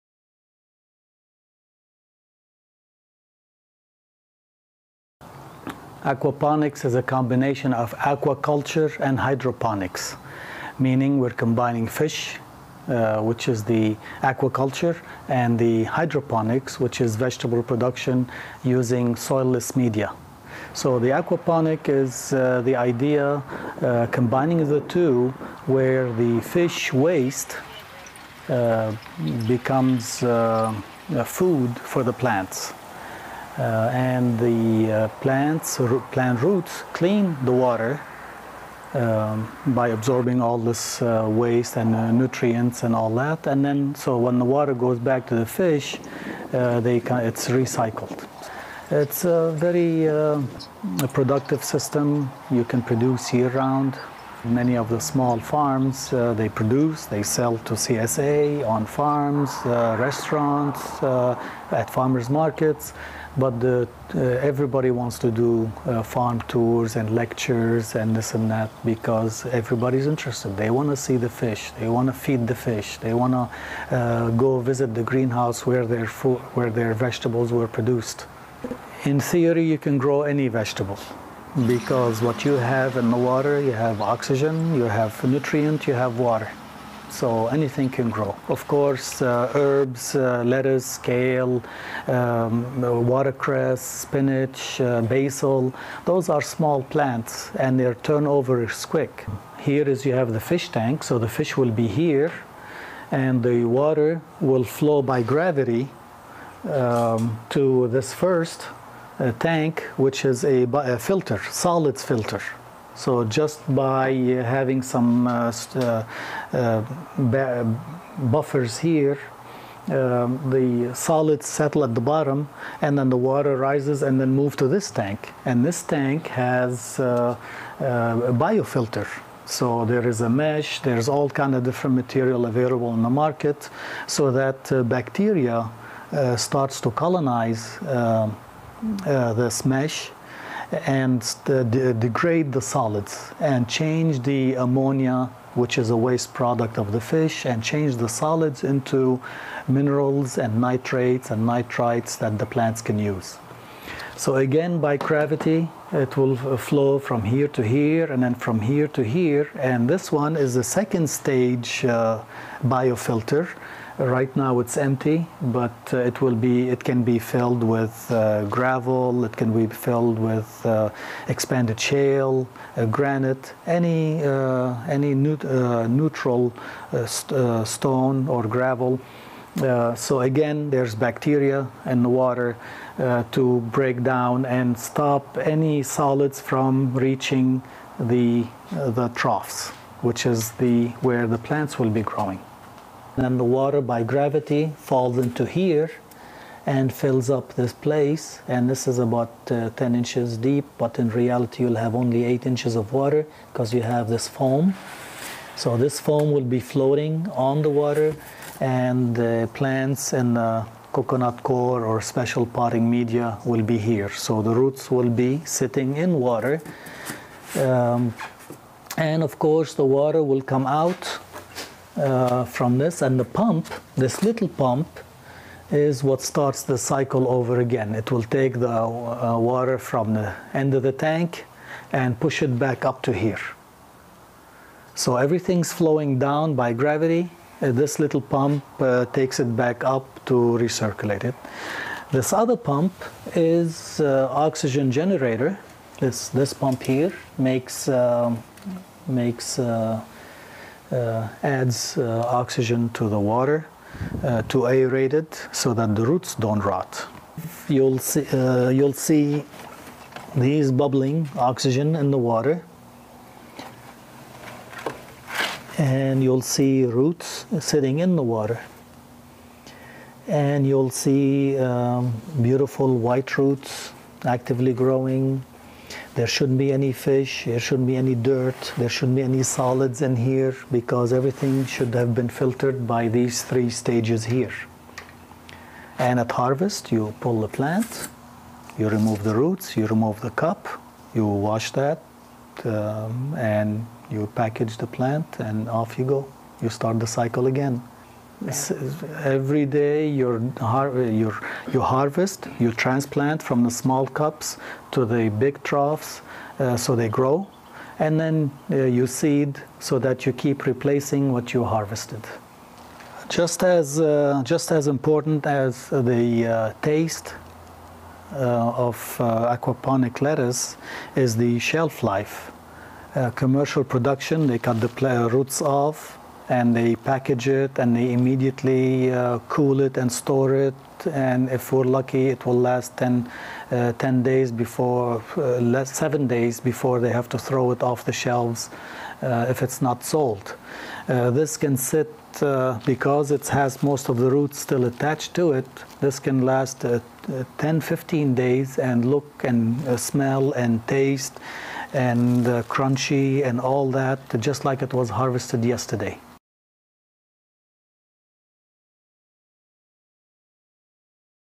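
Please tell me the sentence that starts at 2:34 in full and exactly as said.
So again, by gravity, it will flow from here to here and then from here to here.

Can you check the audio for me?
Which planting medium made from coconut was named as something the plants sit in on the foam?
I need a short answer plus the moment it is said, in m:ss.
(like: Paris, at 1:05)
Coconut coir, at 3:30.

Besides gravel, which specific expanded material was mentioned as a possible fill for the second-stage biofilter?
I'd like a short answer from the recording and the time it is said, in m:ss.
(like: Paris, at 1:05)
Expanded shale, at 2:51.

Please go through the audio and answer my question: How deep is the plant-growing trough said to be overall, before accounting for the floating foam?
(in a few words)
10 inches.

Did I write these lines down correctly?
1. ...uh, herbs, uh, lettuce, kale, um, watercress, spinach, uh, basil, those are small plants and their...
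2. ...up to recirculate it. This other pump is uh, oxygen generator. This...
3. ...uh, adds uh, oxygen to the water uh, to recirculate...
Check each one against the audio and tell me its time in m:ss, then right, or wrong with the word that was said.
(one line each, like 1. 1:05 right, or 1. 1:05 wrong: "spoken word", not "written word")
1. 1:29 right
2. 3:59 right
3. 4:10 wrong: "aerate", not "recirculate".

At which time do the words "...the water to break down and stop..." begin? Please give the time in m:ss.
3:02.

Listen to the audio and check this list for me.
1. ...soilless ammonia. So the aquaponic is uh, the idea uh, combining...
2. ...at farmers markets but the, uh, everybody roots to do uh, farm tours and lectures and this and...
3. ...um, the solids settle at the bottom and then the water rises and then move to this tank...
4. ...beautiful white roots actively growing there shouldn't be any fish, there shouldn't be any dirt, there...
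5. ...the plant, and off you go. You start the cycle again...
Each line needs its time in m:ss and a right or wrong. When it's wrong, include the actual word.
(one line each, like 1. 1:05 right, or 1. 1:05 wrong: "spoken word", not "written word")
1. 0:19 wrong: "media", not "ammonia"
2. 1:01 wrong: "wants", not "roots"
3. 1:59 right
4. 4:32 right
5. 4:54 right.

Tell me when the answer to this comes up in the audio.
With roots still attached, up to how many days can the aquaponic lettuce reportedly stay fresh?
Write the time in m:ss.
5:47.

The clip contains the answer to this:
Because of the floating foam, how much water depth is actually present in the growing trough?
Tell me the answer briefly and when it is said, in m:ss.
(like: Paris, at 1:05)
8 inches, at 3:22.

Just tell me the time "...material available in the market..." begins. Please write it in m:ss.
2:11.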